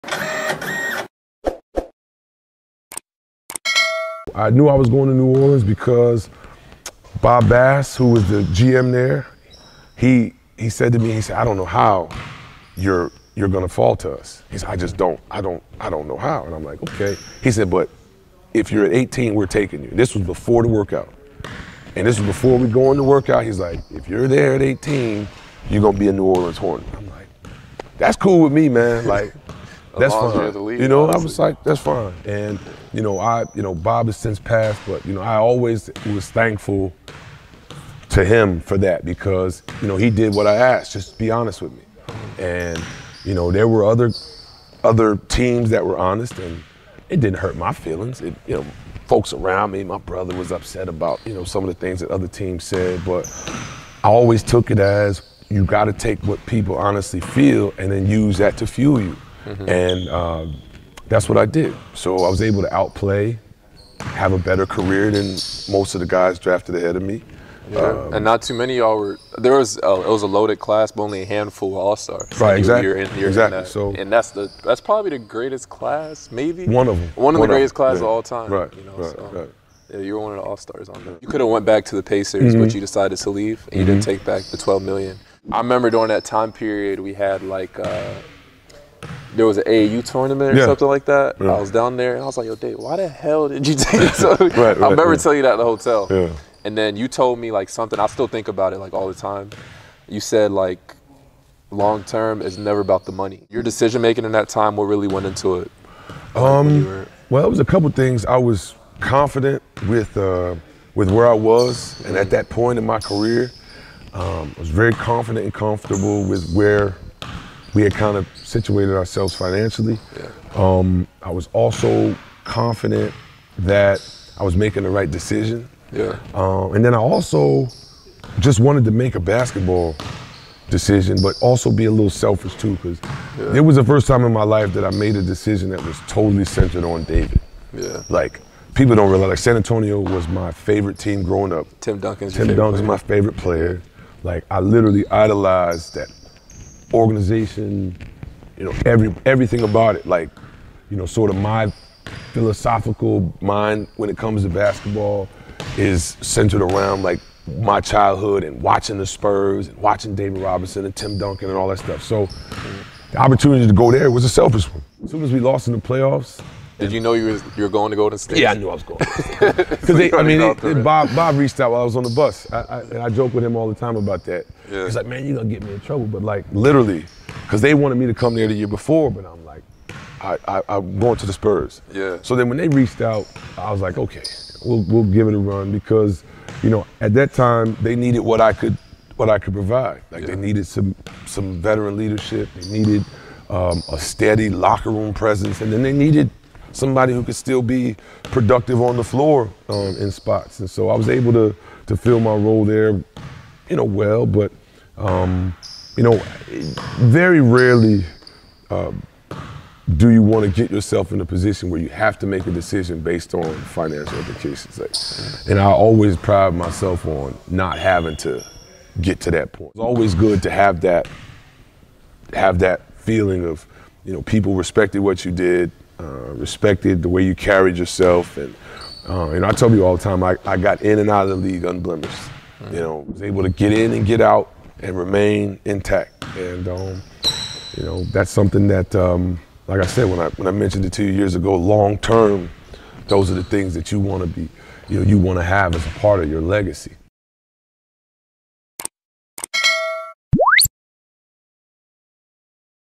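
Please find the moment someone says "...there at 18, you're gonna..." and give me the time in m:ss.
0:24.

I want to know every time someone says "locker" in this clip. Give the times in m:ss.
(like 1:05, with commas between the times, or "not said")
3:14.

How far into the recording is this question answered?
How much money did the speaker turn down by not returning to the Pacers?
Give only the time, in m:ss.
1:24.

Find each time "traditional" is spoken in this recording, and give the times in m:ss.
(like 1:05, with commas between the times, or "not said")
not said.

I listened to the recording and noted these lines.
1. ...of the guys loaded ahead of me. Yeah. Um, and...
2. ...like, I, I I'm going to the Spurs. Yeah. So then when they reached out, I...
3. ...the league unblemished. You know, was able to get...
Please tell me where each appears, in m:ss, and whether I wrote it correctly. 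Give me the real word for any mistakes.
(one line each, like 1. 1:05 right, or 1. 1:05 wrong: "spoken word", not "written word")
1. 1:05 wrong: "drafted", not "loaded"
2. 2:59 right
3. 3:51 right.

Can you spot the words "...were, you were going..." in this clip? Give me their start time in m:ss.
2:47.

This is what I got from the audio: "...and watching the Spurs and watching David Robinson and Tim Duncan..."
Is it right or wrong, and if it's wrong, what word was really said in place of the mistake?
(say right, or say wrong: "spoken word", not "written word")
right.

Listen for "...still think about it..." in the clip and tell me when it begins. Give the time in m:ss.
1:38.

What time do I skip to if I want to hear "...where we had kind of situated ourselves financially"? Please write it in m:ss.
1:56.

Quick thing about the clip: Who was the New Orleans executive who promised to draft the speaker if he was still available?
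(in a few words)
Bob Bass.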